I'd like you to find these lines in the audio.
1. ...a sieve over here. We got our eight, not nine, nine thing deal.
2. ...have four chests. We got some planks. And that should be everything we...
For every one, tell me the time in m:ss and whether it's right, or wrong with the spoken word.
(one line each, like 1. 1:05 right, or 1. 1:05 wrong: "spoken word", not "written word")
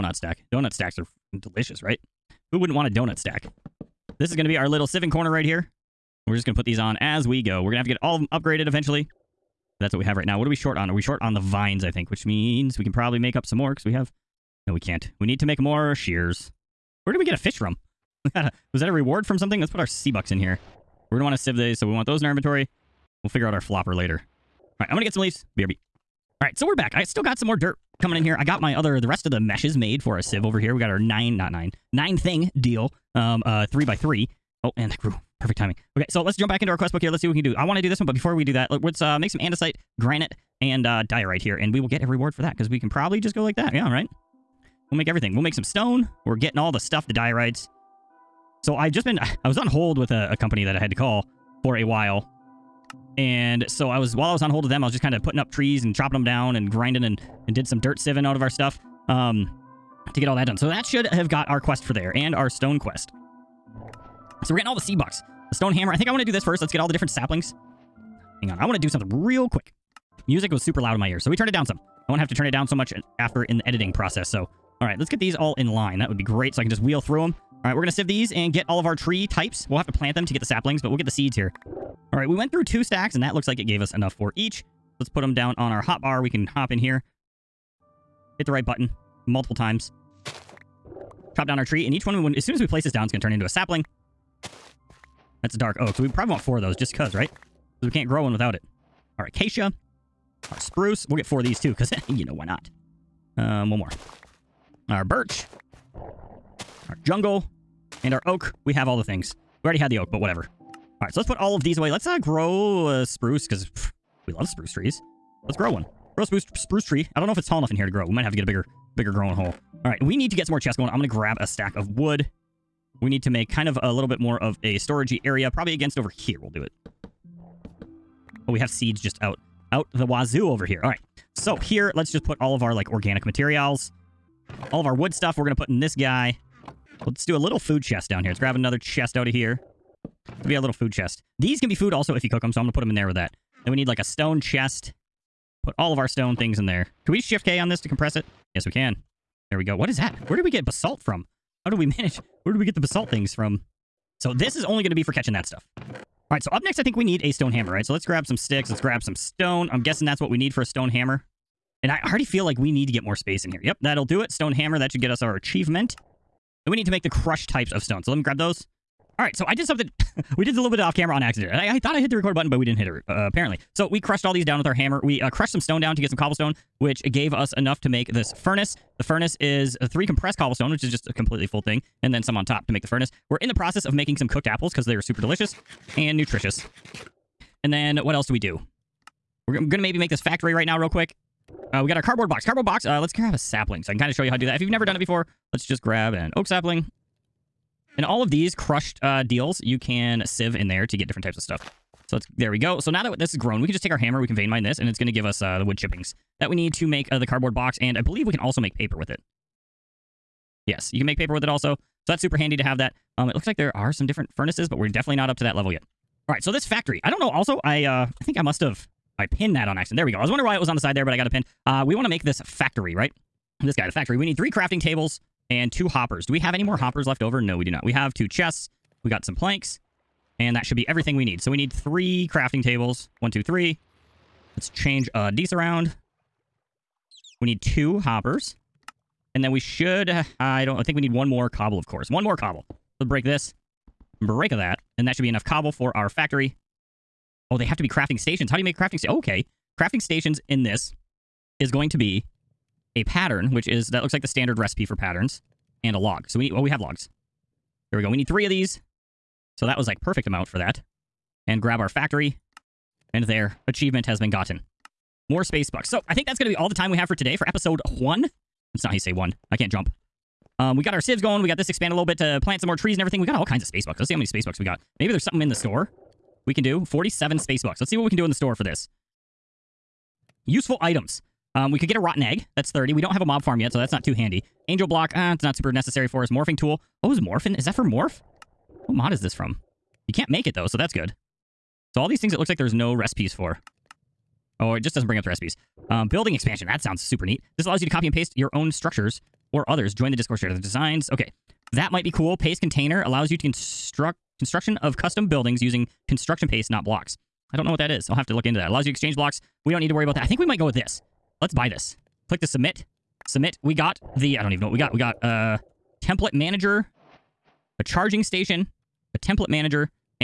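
1. 0:30 wrong: "nine", not "eight"
2. 3:47 wrong: "two", not "four".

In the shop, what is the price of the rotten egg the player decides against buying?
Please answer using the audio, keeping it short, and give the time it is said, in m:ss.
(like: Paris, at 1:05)
30, at 4:42.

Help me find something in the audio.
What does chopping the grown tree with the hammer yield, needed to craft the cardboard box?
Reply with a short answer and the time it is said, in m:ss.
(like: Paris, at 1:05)
wood chippings, at 3:25.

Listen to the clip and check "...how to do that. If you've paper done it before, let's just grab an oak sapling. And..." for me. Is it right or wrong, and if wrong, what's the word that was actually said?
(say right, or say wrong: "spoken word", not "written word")
wrong: "never", not "paper".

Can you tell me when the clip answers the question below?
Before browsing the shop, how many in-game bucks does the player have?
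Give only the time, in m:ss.
4:36.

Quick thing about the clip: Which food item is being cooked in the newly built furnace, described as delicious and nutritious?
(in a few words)
cooked apples.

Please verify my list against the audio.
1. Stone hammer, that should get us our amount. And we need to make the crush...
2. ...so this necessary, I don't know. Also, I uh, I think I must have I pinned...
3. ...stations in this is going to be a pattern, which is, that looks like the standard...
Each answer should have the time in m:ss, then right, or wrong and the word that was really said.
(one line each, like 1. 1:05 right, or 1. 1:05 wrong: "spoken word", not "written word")
1. 2:44 wrong: "achievement", not "amount"
2. 3:36 wrong: "factory", not "necessary"
3. 4:10 right.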